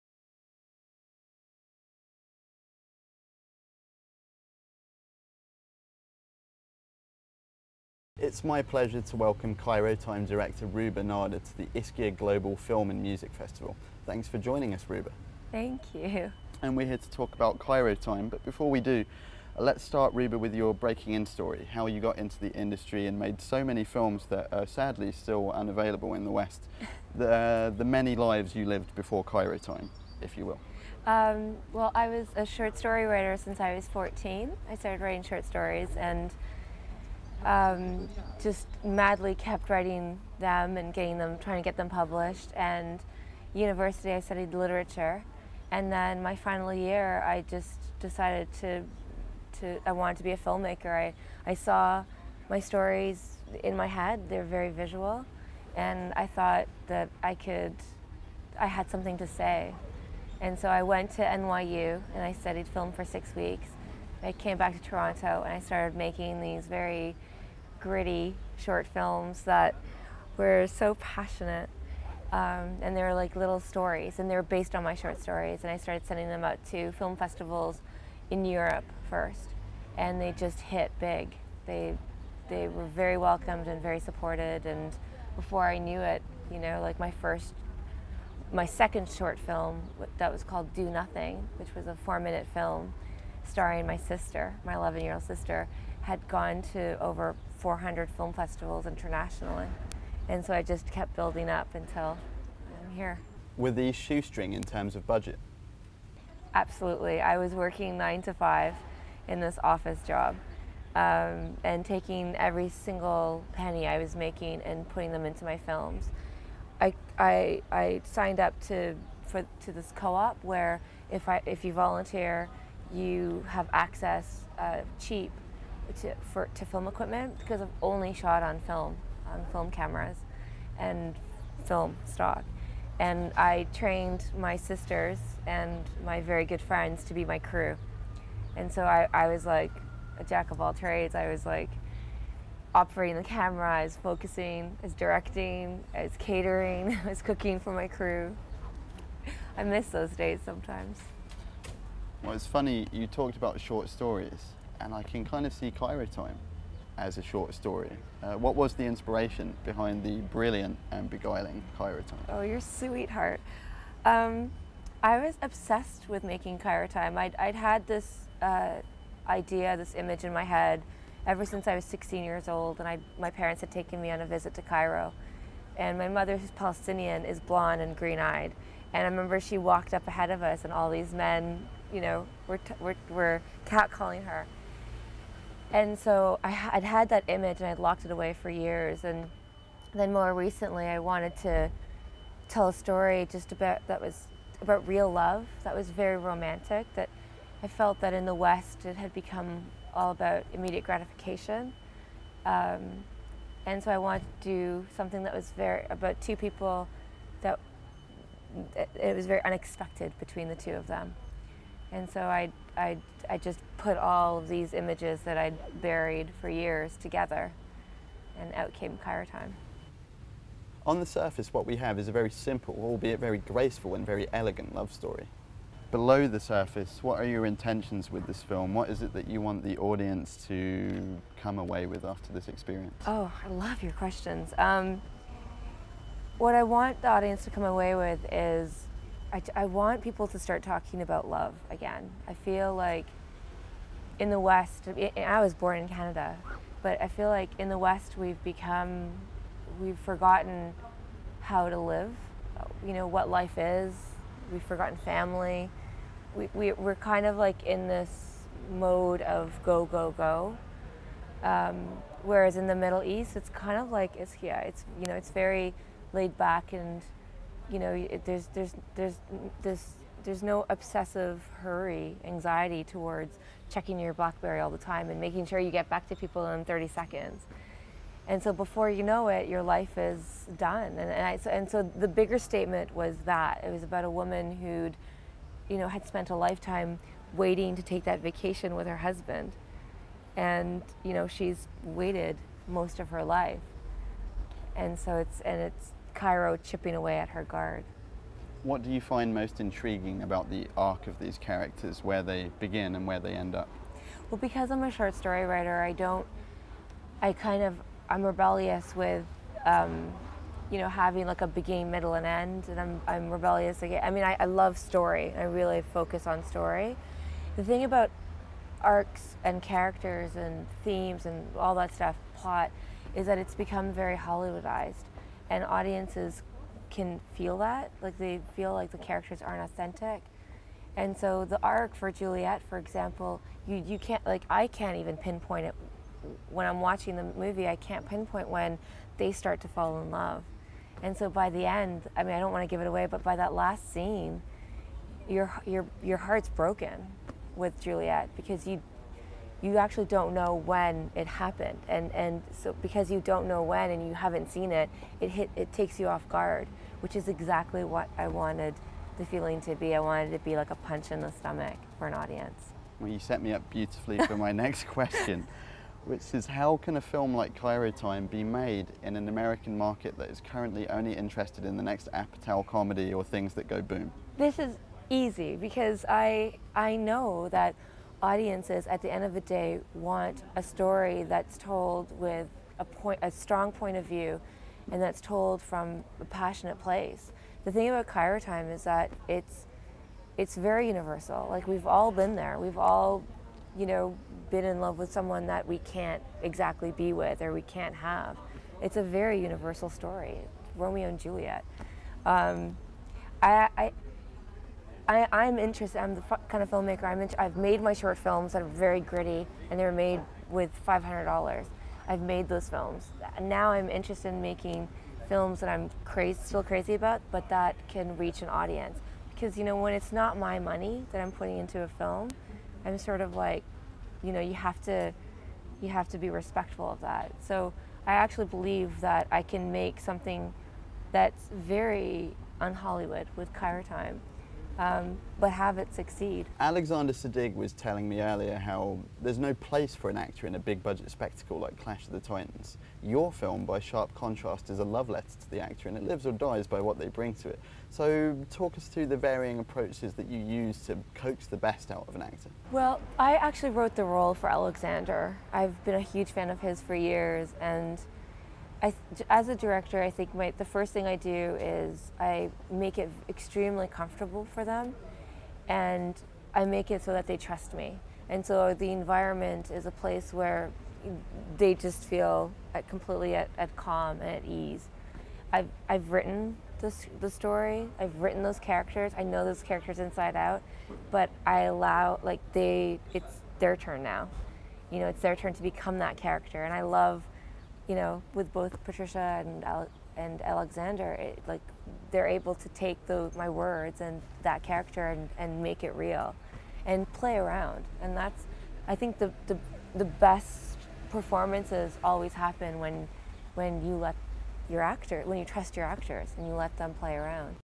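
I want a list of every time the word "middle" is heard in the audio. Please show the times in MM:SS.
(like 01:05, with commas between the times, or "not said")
04:22, 05:11.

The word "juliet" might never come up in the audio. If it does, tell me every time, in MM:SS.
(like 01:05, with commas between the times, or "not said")
05:32, 05:47, 06:41.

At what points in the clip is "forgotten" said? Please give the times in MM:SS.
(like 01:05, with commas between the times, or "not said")
04:09, 04:14.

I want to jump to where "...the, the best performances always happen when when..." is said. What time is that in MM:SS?
08:19.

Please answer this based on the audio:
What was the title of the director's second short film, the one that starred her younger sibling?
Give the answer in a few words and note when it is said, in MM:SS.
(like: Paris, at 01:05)
Do Nothing, at 01:30.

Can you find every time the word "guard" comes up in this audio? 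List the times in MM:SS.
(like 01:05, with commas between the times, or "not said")
04:57, 05:56.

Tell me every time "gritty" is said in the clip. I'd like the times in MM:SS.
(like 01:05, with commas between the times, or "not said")
01:07, 06:49.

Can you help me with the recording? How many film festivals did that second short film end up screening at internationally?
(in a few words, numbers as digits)
400.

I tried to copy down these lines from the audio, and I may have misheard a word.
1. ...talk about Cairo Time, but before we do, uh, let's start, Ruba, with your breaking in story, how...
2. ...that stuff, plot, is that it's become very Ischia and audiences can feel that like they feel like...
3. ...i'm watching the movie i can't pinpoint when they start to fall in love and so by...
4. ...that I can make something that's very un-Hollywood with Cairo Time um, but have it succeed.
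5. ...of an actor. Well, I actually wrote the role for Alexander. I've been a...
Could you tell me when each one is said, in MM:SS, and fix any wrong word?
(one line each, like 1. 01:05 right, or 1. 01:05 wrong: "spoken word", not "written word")
1. 00:17 right
2. 05:21 wrong: "Hollywoodized", not "Ischia"
3. 05:36 right
4. 07:09 right
5. 07:32 right.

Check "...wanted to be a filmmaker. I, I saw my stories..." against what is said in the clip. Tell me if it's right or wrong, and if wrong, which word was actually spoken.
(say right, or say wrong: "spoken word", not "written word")
right.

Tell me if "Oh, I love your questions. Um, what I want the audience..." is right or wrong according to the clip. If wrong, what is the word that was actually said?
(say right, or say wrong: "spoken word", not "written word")
right.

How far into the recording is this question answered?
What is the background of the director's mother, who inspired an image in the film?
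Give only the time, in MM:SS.
02:56.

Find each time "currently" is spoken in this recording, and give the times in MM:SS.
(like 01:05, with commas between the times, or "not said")
06:10.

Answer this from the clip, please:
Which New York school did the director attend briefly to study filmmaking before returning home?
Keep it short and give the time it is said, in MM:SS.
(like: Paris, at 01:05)
NYU, at 01:01.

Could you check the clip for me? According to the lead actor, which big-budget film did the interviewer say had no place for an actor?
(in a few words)
Clash of the Titans.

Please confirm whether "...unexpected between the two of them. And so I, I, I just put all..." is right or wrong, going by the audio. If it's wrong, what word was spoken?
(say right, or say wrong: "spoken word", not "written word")
right.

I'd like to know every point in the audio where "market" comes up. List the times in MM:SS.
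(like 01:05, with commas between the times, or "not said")
06:09.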